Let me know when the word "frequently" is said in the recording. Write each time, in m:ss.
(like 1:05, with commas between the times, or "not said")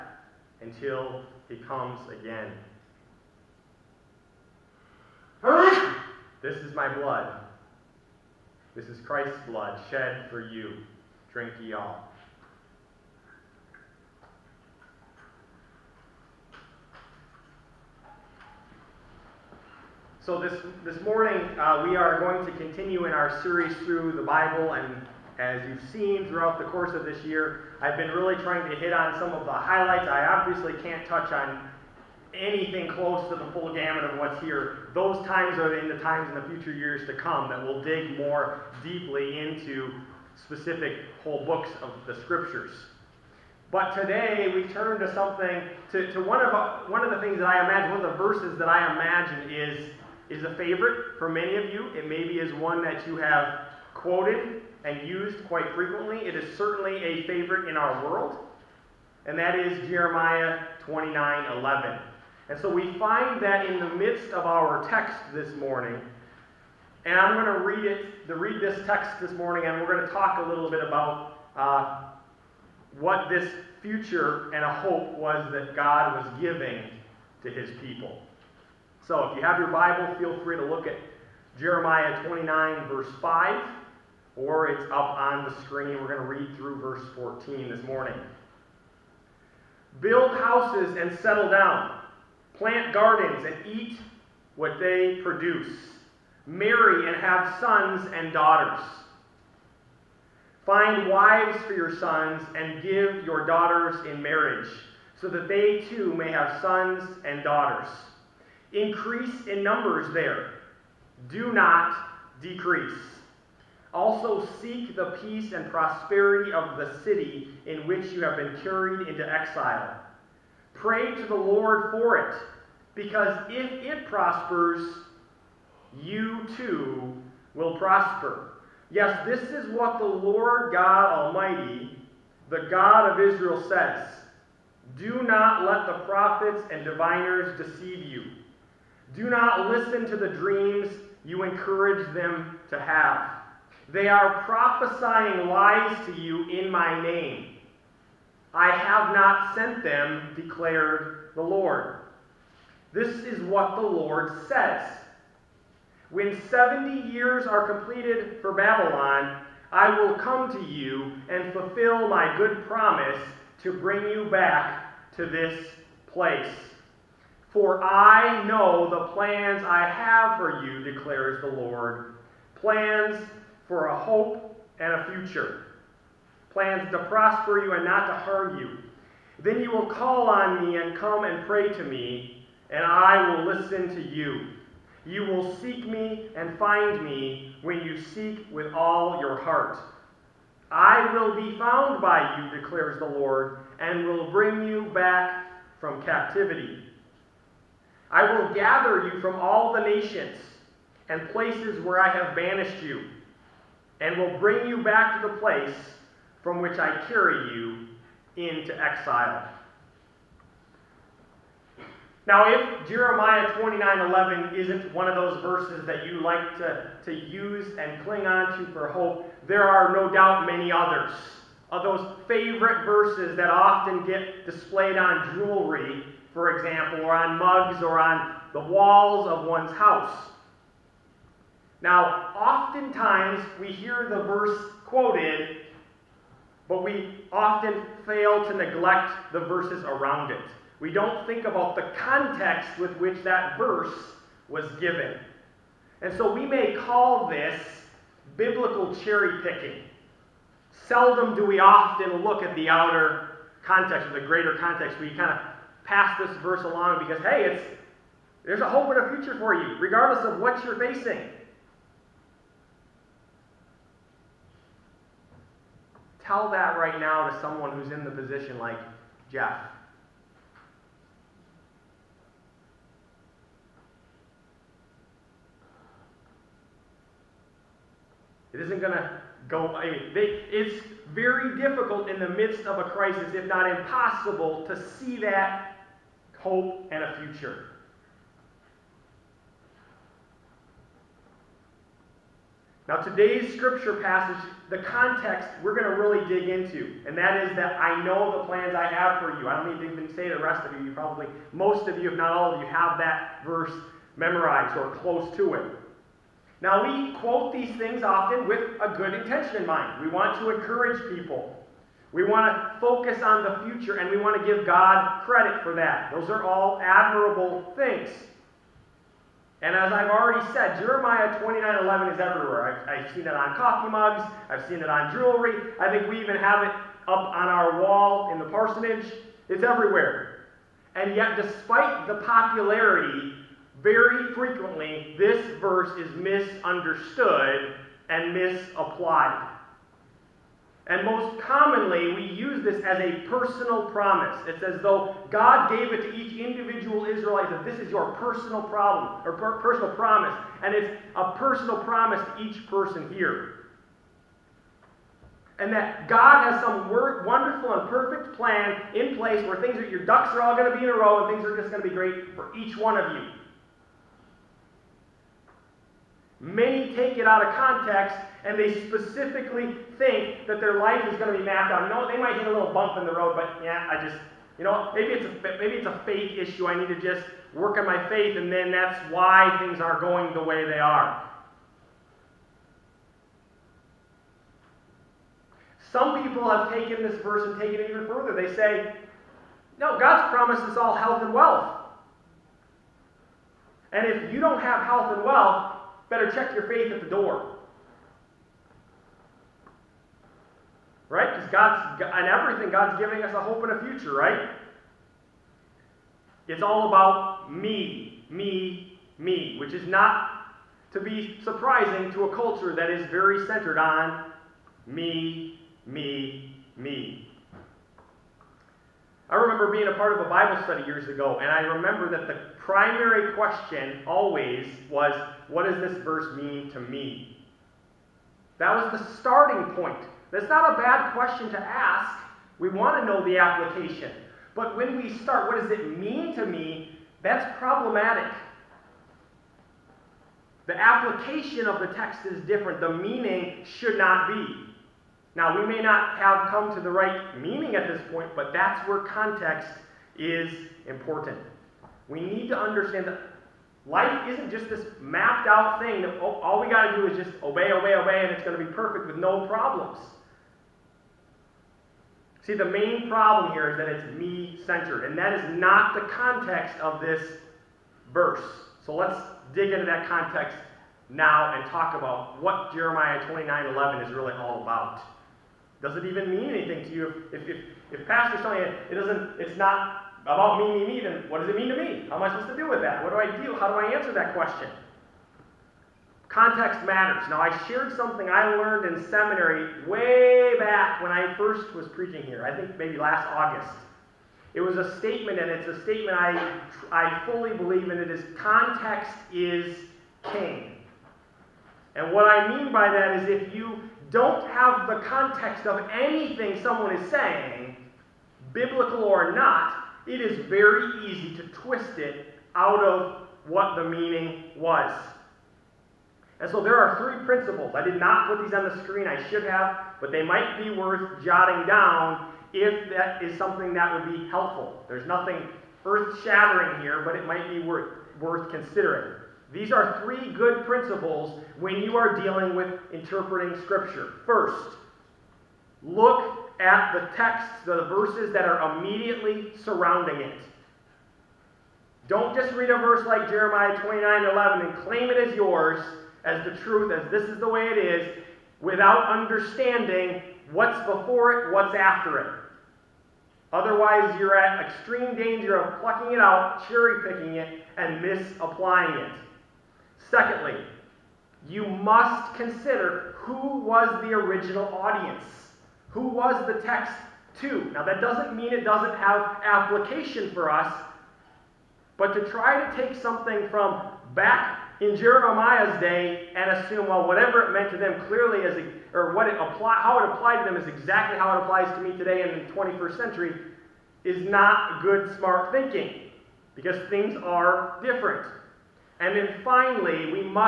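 0:55, 5:34.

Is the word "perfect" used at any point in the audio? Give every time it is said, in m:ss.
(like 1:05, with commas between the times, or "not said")
5:57, 7:38.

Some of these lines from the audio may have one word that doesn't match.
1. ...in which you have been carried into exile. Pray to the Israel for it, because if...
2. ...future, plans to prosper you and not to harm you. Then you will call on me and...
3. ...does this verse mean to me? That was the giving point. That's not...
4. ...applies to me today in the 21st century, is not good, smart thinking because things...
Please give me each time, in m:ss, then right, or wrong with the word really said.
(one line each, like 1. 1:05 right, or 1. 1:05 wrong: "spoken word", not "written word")
1. 1:57 wrong: "Lord", not "Israel"
2. 2:55 right
3. 7:05 wrong: "starting", not "giving"
4. 9:41 right.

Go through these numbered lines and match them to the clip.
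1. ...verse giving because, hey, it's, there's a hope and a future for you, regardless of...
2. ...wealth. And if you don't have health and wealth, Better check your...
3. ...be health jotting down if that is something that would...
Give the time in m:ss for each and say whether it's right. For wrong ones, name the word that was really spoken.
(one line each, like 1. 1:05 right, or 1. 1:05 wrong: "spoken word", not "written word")
1. 4:16 wrong: "along", not "giving"
2. 6:31 right
3. 8:40 wrong: "worth", not "health".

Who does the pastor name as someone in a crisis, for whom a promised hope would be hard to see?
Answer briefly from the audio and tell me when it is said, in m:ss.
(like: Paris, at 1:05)
Jeff, at 4:29.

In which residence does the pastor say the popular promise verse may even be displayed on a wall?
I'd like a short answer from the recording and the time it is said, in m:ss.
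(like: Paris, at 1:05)
The parsonage, at 5:28.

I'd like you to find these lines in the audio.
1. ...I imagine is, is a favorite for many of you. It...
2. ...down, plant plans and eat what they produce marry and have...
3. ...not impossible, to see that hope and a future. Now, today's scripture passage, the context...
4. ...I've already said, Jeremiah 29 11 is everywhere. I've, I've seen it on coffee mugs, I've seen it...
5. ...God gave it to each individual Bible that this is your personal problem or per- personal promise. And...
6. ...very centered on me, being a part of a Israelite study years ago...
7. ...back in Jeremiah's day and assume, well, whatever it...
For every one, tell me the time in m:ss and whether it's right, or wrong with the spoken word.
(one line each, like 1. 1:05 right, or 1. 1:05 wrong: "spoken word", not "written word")
1. 0:48 right
2. 1:31 wrong: "gardens", not "plans"
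3. 4:43 right
4. 5:19 right
5. 5:45 wrong: "Israelite", not "Bible"
6. 6:53 wrong: "Bible", not "Israelite"
7. 9:34 right.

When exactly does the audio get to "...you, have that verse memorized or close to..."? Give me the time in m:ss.
5:02.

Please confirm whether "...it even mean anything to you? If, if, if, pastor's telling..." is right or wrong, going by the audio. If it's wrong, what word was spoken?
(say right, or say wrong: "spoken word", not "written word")
right.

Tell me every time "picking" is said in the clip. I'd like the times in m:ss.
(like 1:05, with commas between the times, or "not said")
4:09, 9:17.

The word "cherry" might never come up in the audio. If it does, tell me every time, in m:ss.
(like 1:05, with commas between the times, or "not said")
4:08, 9:16.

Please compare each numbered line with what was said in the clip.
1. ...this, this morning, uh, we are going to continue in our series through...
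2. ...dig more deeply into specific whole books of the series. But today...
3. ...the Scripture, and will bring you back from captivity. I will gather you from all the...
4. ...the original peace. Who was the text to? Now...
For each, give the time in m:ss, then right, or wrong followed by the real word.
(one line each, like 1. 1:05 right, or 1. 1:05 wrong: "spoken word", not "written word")
1. 0:20 right
2. 0:37 wrong: "scriptures", not "series"
3. 3:12 wrong: "Lord", not "Scripture"
4. 9:24 wrong: "audience", not "peace".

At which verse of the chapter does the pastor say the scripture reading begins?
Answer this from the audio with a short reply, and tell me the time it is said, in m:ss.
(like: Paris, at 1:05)
Verse 5, at 1:22.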